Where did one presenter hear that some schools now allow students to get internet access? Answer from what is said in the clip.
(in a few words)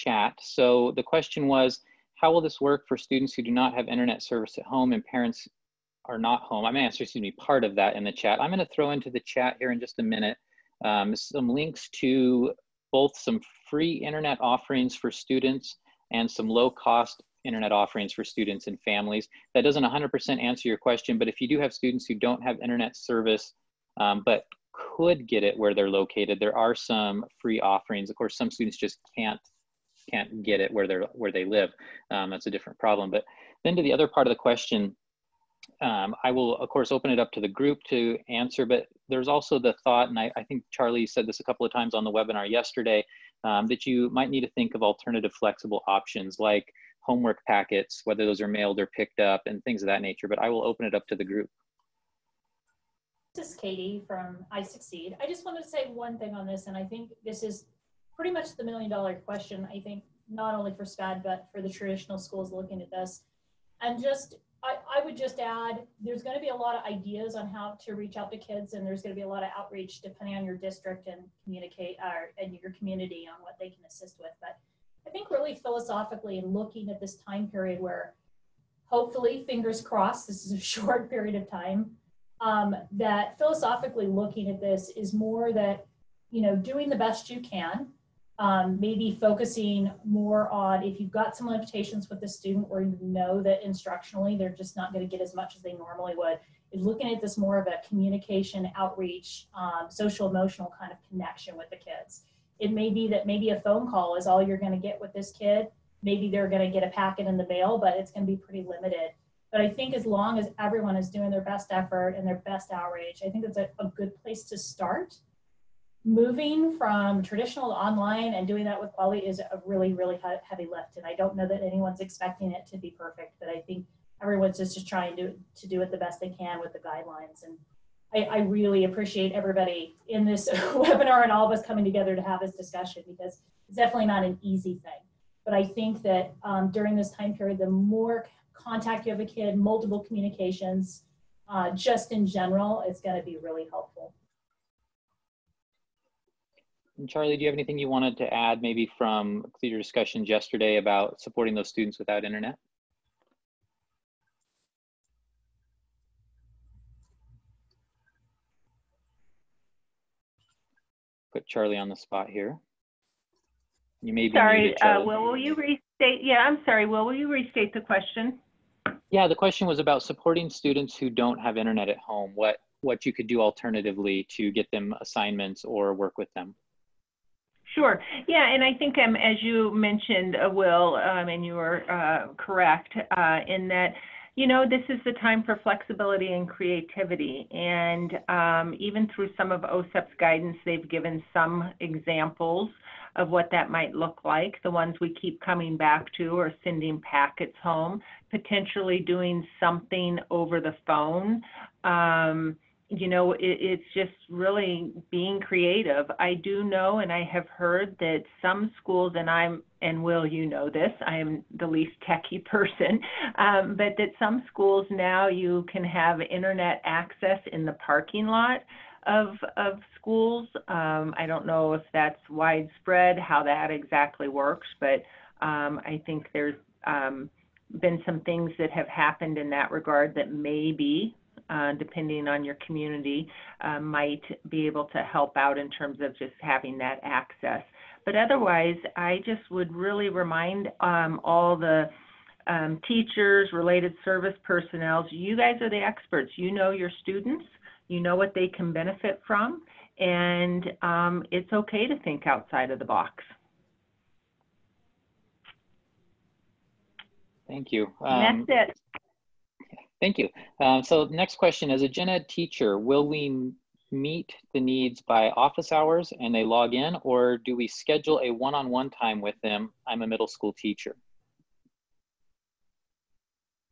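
the parking lot.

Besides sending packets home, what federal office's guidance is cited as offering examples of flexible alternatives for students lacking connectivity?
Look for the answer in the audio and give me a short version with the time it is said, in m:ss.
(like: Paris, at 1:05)
OSEP, at 3:09.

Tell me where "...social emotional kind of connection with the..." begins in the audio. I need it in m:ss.
1:39.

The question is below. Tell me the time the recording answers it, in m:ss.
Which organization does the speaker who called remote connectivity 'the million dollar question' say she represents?
0:54.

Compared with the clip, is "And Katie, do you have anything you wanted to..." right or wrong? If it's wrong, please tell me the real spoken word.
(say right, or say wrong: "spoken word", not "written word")
wrong: "Charlie", not "Katie".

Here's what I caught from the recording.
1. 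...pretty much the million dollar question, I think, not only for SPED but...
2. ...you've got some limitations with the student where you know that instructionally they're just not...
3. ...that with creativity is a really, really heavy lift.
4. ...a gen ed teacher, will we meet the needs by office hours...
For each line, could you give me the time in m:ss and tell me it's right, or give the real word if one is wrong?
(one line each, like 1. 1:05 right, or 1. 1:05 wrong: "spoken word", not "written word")
1. 0:58 right
2. 1:30 right
3. 1:58 wrong: "quality", not "creativity"
4. 4:21 right.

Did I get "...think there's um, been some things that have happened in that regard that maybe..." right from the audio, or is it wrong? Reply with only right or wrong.
right.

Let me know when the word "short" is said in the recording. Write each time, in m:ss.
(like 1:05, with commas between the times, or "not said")
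1:20.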